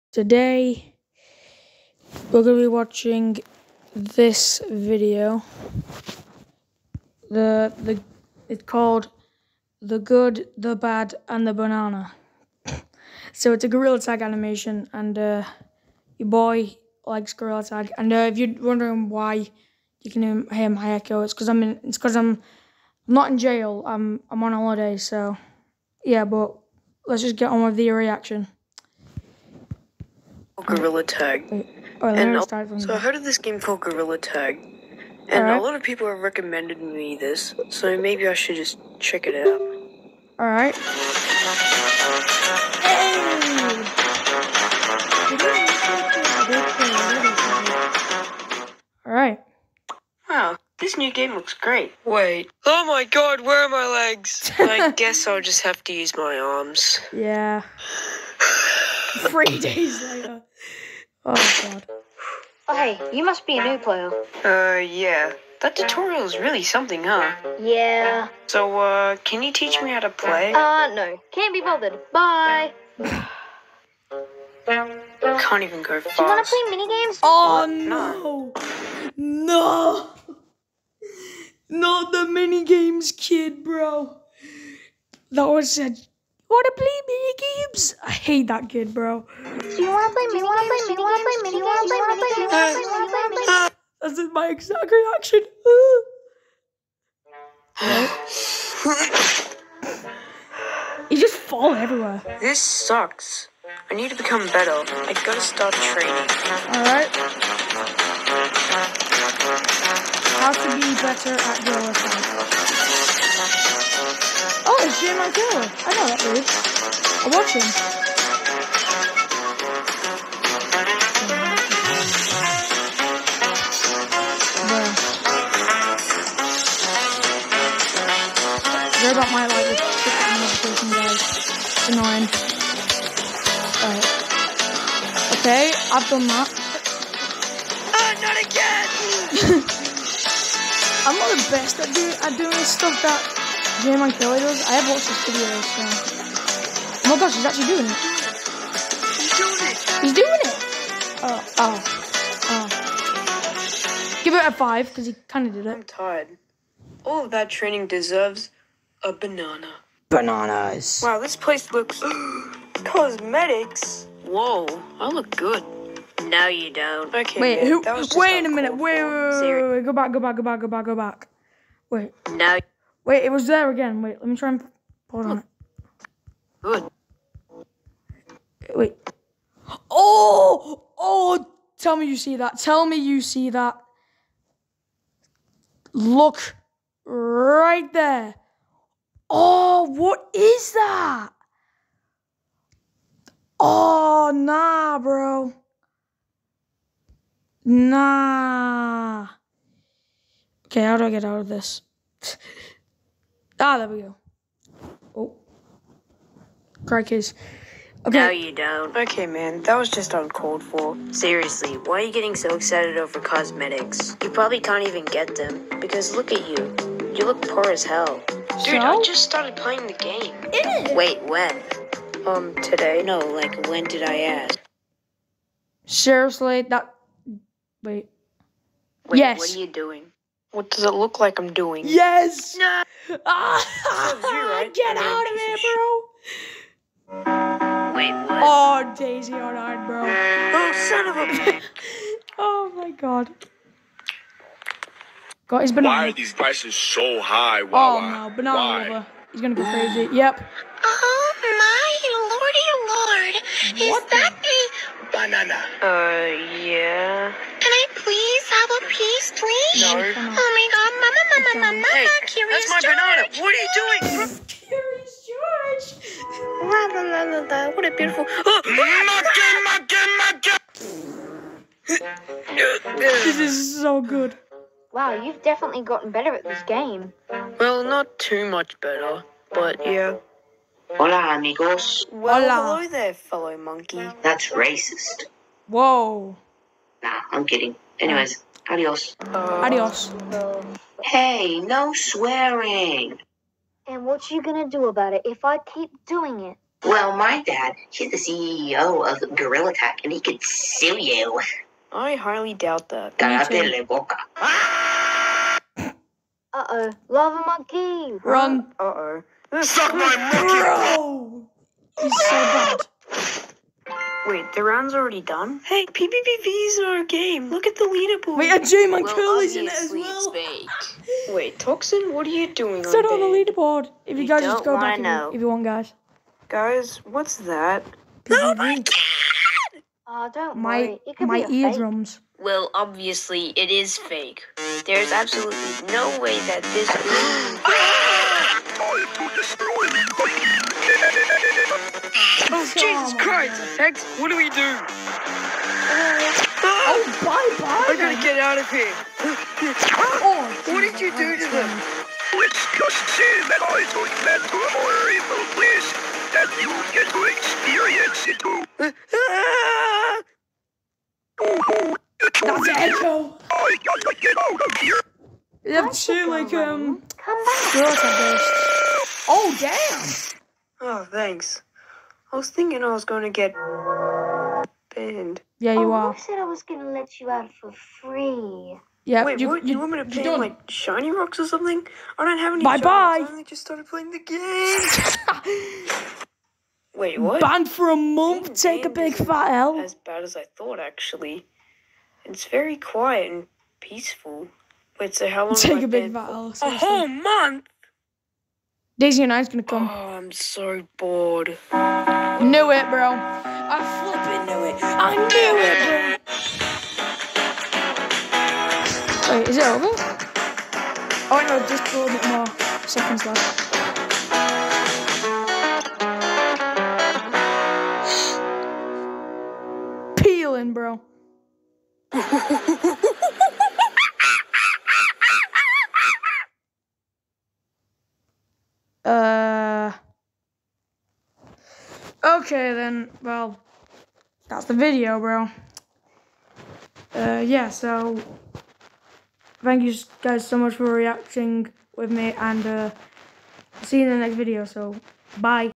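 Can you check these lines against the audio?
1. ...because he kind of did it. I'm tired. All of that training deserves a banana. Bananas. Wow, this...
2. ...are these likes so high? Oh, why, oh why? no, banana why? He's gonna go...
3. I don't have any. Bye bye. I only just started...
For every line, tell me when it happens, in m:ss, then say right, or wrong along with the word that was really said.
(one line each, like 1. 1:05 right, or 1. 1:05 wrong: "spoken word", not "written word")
1. 2:34 right
2. 4:06 wrong: "prices", not "likes"
3. 6:22 right.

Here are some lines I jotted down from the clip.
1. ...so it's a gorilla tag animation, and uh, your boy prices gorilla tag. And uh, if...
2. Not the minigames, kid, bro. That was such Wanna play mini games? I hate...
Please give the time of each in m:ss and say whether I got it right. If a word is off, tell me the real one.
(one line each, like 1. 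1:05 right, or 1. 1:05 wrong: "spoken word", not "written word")
1. 0:13 wrong: "likes", not "prices"
2. 1:21 right.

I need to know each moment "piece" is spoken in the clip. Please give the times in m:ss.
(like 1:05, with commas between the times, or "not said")
4:18.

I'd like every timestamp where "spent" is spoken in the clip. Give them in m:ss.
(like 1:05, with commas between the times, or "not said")
not said.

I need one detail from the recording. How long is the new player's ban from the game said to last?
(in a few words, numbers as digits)
a month.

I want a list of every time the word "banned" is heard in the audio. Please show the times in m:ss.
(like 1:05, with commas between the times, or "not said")
6:14, 6:27.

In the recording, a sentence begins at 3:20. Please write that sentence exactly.
Okay, how do I get out of this?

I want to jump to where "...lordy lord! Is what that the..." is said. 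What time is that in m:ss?
4:13.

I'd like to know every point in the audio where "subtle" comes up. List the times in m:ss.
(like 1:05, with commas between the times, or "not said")
not said.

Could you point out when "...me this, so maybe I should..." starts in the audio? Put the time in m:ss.
0:36.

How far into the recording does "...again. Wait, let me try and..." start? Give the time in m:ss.
2:53.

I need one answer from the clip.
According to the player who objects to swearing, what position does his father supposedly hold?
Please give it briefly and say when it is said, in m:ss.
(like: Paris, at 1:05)
CEO of Gorilla Tag, at 4:58.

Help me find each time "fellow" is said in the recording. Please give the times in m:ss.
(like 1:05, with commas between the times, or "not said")
4:43.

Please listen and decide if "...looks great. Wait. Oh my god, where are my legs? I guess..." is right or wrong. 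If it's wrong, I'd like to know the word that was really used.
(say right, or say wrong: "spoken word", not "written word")
right.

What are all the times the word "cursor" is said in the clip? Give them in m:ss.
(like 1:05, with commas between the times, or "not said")
not said.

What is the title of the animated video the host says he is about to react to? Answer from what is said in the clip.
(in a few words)
The Good, the Bad, and the Banana.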